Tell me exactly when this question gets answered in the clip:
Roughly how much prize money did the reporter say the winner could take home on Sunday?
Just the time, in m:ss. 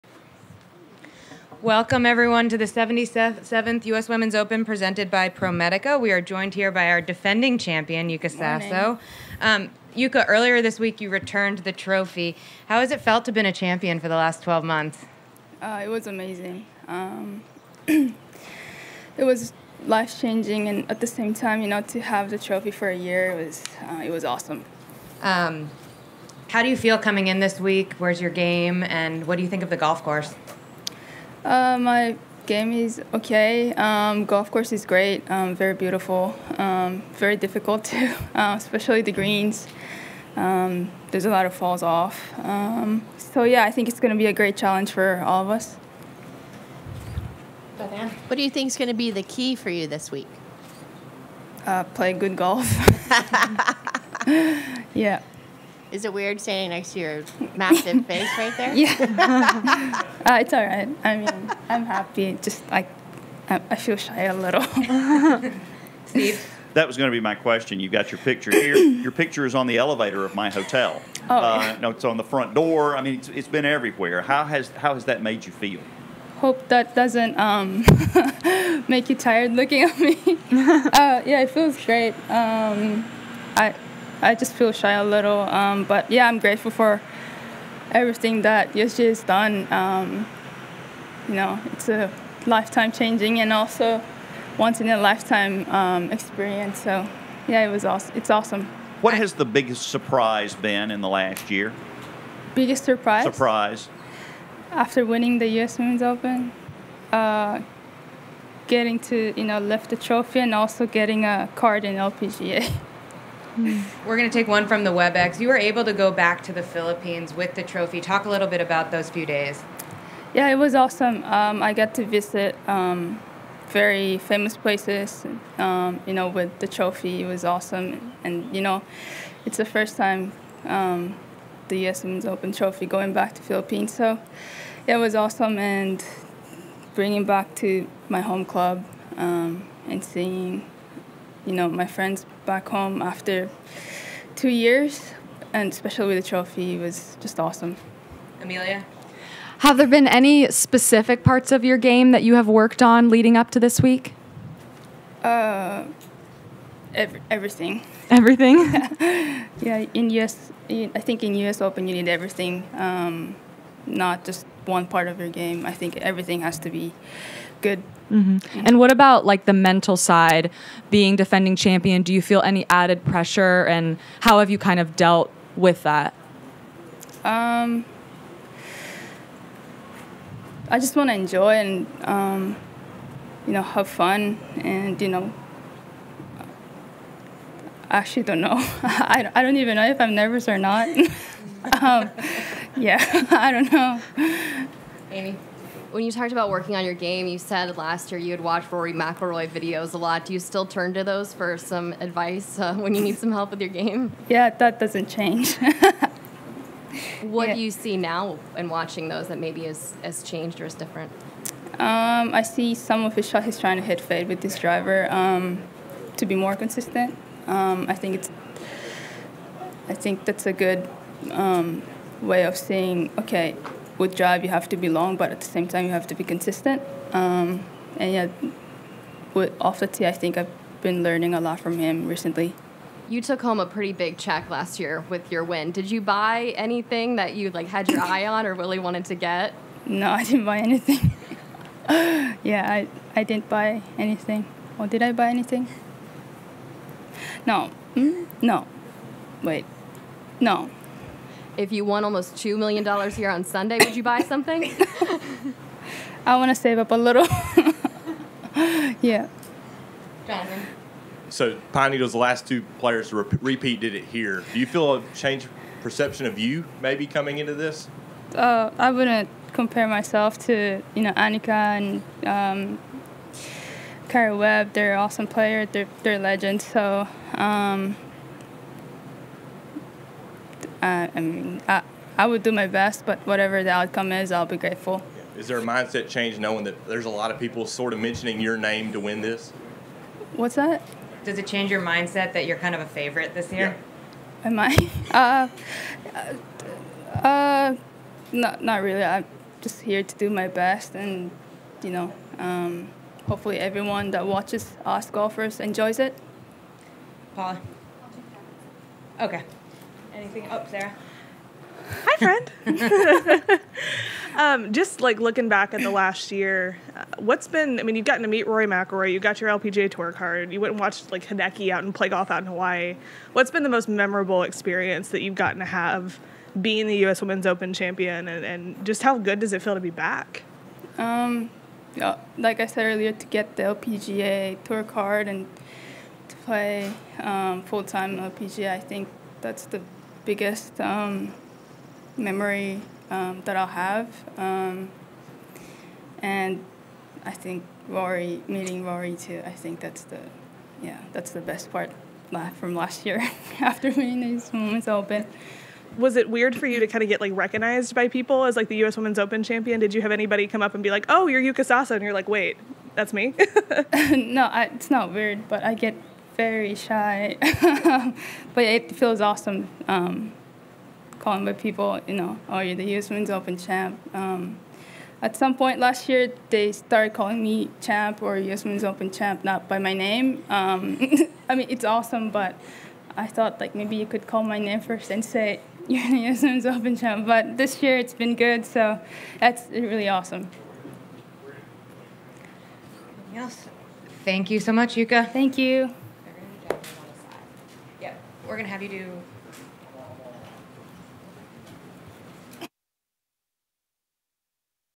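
4:12.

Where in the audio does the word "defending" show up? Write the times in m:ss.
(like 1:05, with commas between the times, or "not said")
0:07, 2:51.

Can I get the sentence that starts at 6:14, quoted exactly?
Um, at some point last year, they started calling me champ or US Women's Open champ, not by my name.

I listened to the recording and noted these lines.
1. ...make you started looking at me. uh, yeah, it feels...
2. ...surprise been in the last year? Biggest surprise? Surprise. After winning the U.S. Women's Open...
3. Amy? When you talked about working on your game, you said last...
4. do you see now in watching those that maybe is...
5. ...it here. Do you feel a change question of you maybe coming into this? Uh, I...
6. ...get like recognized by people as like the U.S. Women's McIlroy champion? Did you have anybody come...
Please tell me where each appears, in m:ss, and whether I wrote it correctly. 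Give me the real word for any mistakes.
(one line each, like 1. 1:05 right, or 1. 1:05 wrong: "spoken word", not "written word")
1. 1:18 wrong: "tired", not "started"
2. 1:39 right
3. 3:15 right
4. 3:27 right
5. 4:23 wrong: "perception", not "question"
6. 5:57 wrong: "Open", not "McIlroy".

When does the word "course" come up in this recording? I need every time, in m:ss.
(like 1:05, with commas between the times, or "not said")
0:30, 0:34.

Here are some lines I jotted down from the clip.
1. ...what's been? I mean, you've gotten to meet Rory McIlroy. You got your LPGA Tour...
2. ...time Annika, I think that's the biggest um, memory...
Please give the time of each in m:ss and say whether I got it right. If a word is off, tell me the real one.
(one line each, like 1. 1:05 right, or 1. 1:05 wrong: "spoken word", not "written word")
1. 5:17 right
2. 5:37 wrong: "LPGA", not "Annika".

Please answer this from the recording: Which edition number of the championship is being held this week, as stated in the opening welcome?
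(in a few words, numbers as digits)
77th.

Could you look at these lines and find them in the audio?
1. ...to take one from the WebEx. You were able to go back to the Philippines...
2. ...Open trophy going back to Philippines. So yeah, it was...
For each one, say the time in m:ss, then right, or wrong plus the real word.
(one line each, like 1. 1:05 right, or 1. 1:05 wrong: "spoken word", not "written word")
1. 1:54 right
2. 2:12 right.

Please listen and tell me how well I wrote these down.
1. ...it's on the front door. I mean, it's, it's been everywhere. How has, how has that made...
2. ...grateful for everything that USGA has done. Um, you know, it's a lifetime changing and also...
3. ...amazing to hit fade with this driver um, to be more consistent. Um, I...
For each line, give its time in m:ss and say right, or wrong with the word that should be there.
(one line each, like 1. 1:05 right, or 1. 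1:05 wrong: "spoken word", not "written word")
1. 1:11 right
2. 1:26 right
3. 3:33 wrong: "trying", not "amazing".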